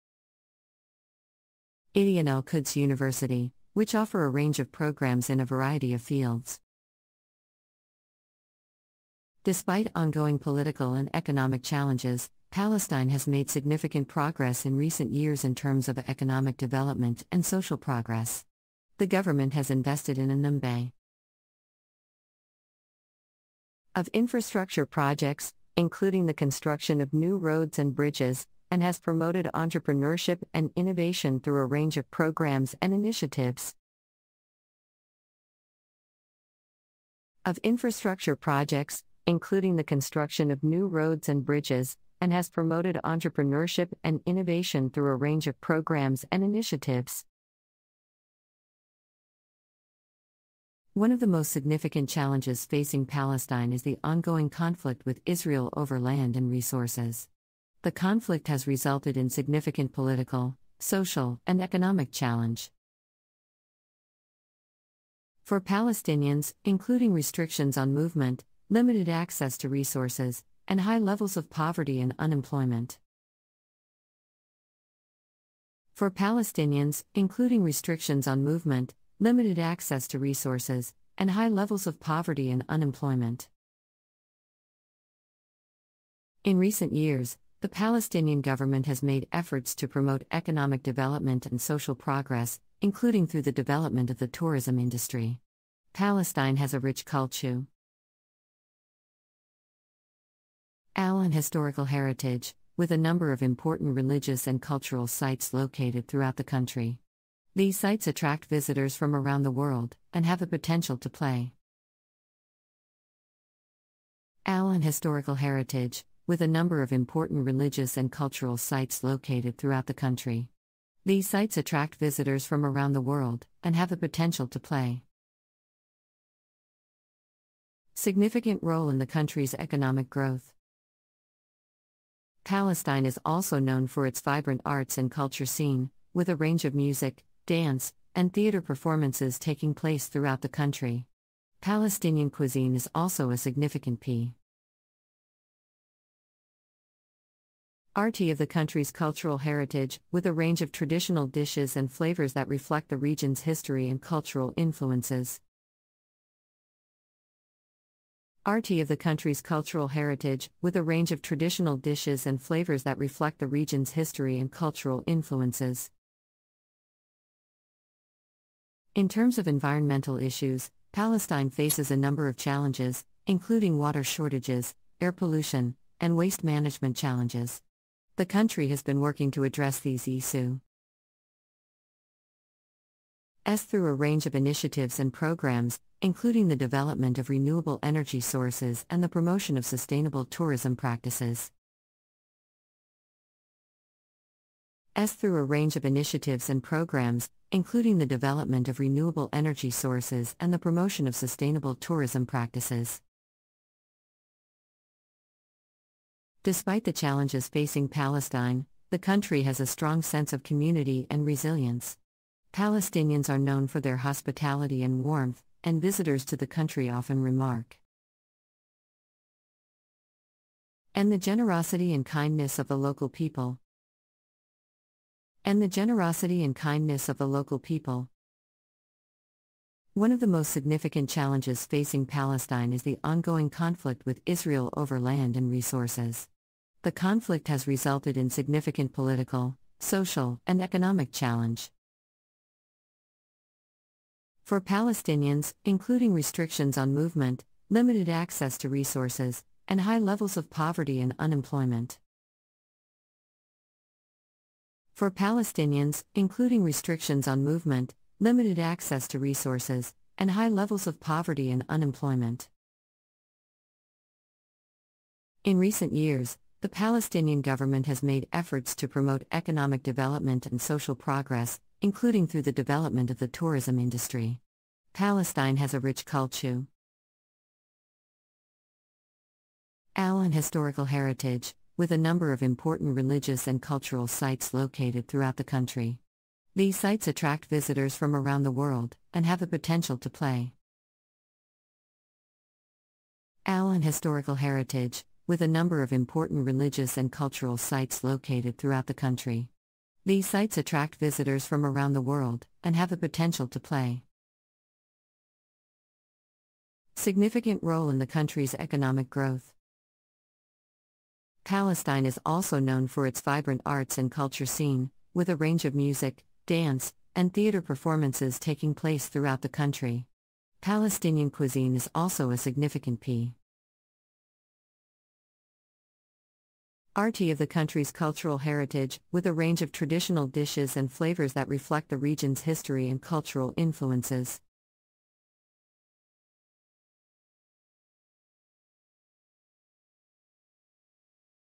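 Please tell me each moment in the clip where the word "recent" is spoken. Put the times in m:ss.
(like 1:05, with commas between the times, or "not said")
0:14, 1:26, 4:25.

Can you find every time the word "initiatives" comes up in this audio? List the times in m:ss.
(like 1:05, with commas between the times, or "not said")
0:32, 0:46, 3:04, 3:15.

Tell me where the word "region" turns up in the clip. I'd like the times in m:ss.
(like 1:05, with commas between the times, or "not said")
2:32, 2:43, 5:31.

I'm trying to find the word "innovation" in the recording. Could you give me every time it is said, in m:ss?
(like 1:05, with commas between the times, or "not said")
0:30, 0:44.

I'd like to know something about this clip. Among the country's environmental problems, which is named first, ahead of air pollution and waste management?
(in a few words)
water shortages.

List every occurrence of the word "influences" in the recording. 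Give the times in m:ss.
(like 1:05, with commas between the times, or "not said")
2:34, 2:45, 5:33.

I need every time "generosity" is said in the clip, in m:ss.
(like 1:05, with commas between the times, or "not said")
3:41, 3:45.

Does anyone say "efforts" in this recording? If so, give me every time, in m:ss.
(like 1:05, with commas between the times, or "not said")
1:29, 4:28.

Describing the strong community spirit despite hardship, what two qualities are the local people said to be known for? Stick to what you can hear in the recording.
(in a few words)
hospitality and warmth.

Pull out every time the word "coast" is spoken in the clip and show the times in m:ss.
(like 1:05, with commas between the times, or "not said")
not said.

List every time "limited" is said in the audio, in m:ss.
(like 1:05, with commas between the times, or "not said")
1:08, 1:19, 4:07, 4:18.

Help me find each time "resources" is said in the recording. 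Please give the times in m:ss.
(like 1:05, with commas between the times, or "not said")
0:56, 1:09, 1:20, 3:55, 4:08, 4:19.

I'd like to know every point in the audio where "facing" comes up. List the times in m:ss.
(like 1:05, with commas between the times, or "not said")
0:52, 3:27, 3:51.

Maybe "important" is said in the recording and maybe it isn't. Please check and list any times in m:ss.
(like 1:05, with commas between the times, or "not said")
1:43, 1:56, 4:42, 4:55.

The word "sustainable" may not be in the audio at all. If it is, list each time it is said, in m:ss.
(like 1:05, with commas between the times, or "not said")
3:09, 3:21.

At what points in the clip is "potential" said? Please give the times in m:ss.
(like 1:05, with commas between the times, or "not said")
1:50, 2:03, 4:49, 5:02.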